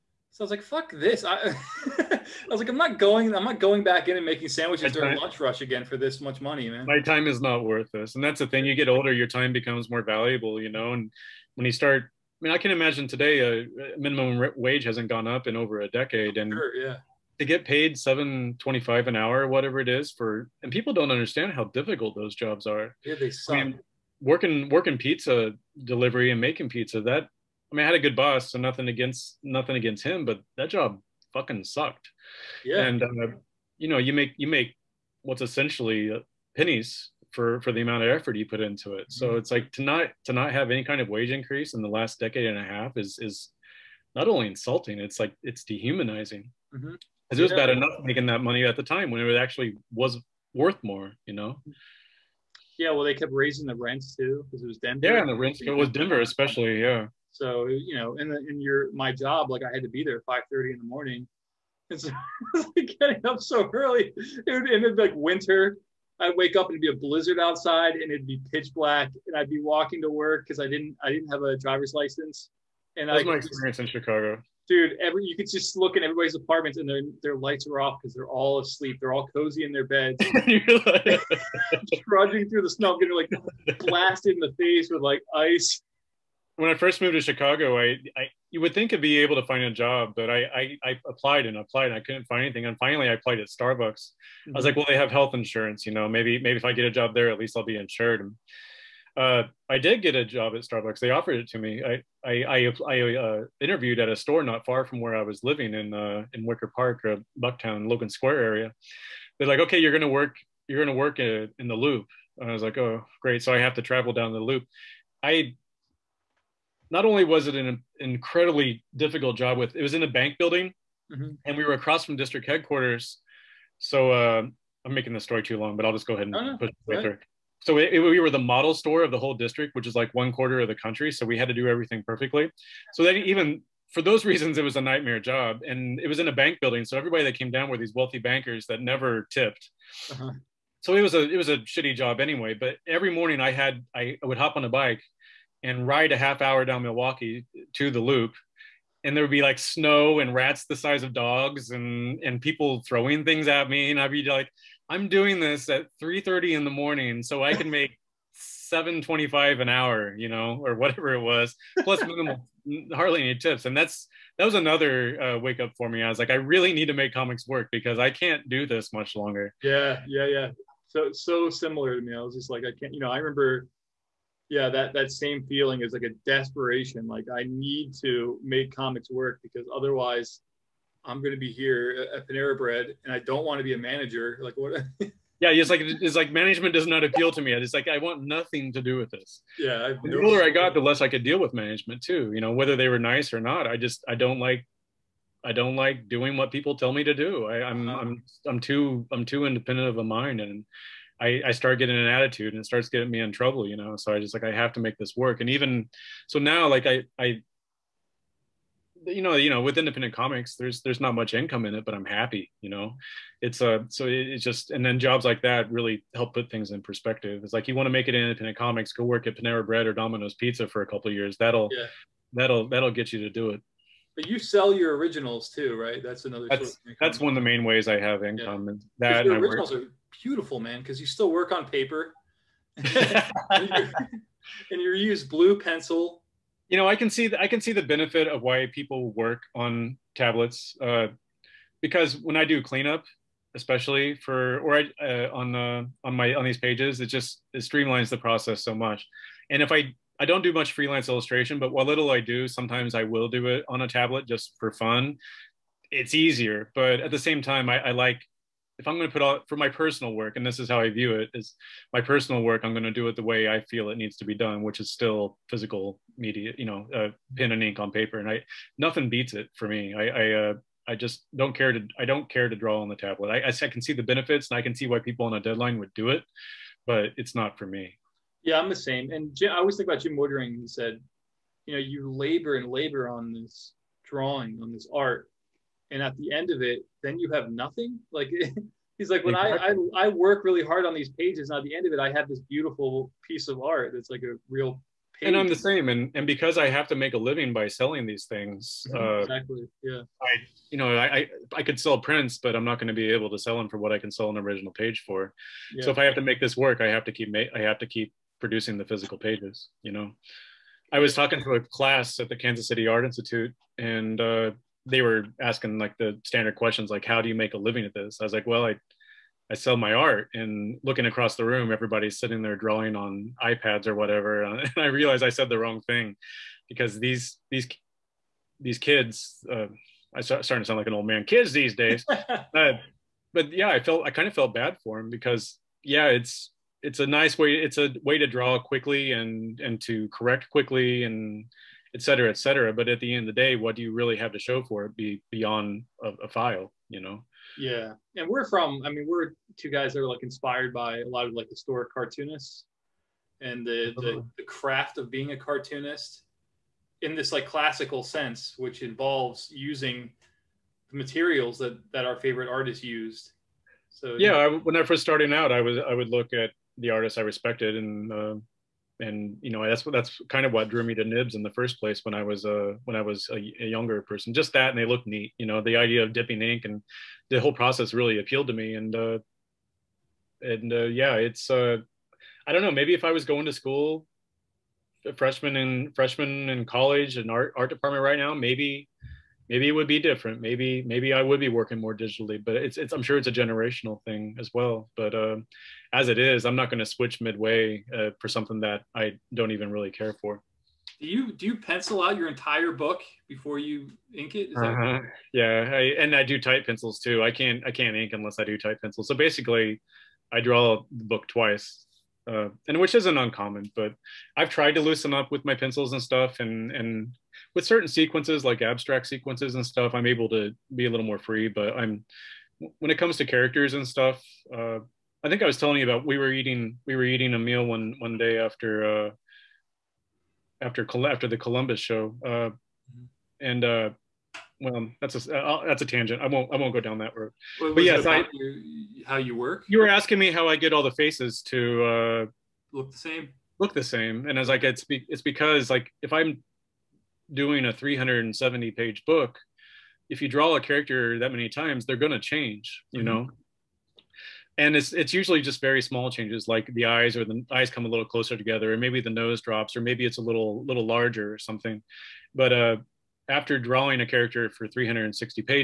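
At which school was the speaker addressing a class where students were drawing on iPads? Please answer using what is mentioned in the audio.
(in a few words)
Kansas City Art Institute.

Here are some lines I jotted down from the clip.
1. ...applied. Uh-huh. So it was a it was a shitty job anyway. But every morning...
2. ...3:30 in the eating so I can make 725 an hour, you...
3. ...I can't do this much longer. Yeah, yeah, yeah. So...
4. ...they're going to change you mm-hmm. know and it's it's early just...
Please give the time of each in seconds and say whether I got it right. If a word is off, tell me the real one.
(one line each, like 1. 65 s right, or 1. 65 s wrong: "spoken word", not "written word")
1. 139 s wrong: "tipped", not "applied"
2. 156 s wrong: "morning", not "eating"
3. 167 s right
4. 451 s wrong: "usually", not "early".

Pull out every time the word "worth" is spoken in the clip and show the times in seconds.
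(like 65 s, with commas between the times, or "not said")
7 s, 50 s.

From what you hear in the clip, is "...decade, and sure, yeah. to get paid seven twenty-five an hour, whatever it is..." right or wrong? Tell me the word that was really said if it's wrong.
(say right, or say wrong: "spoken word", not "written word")
right.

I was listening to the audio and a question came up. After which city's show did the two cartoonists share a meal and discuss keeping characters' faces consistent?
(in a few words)
Columbus.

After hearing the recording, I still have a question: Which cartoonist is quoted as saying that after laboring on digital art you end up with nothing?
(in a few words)
Jim Woodring.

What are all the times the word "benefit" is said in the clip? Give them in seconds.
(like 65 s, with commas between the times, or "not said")
237 s, 274 s.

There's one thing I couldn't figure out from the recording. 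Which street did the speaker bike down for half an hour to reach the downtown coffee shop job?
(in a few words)
Milwaukee.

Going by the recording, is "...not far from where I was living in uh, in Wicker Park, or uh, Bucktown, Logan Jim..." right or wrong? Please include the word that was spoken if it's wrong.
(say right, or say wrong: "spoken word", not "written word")
wrong: "Square", not "Jim".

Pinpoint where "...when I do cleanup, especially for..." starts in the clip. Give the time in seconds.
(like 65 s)
242 s.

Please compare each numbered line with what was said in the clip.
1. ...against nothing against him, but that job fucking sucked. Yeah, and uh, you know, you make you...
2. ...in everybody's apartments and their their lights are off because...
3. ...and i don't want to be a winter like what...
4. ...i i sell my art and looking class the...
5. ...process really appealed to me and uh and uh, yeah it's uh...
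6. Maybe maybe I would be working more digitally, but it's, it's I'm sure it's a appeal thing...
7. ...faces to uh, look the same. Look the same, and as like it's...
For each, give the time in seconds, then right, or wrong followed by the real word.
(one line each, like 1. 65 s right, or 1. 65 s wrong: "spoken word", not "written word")
1. 28 s right
2. 75 s right
3. 183 s wrong: "manager", not "winter"
4. 318 s wrong: "across", not "class"
5. 377 s right
6. 390 s wrong: "generational", not "appeal"
7. 440 s right.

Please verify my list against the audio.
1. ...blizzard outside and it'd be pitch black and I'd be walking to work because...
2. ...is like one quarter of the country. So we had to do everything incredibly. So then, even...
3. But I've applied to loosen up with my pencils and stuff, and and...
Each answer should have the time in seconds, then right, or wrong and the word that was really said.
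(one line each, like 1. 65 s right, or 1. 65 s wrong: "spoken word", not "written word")
1. 67 s right
2. 129 s wrong: "perfectly", not "incredibly"
3. 413 s wrong: "tried", not "applied".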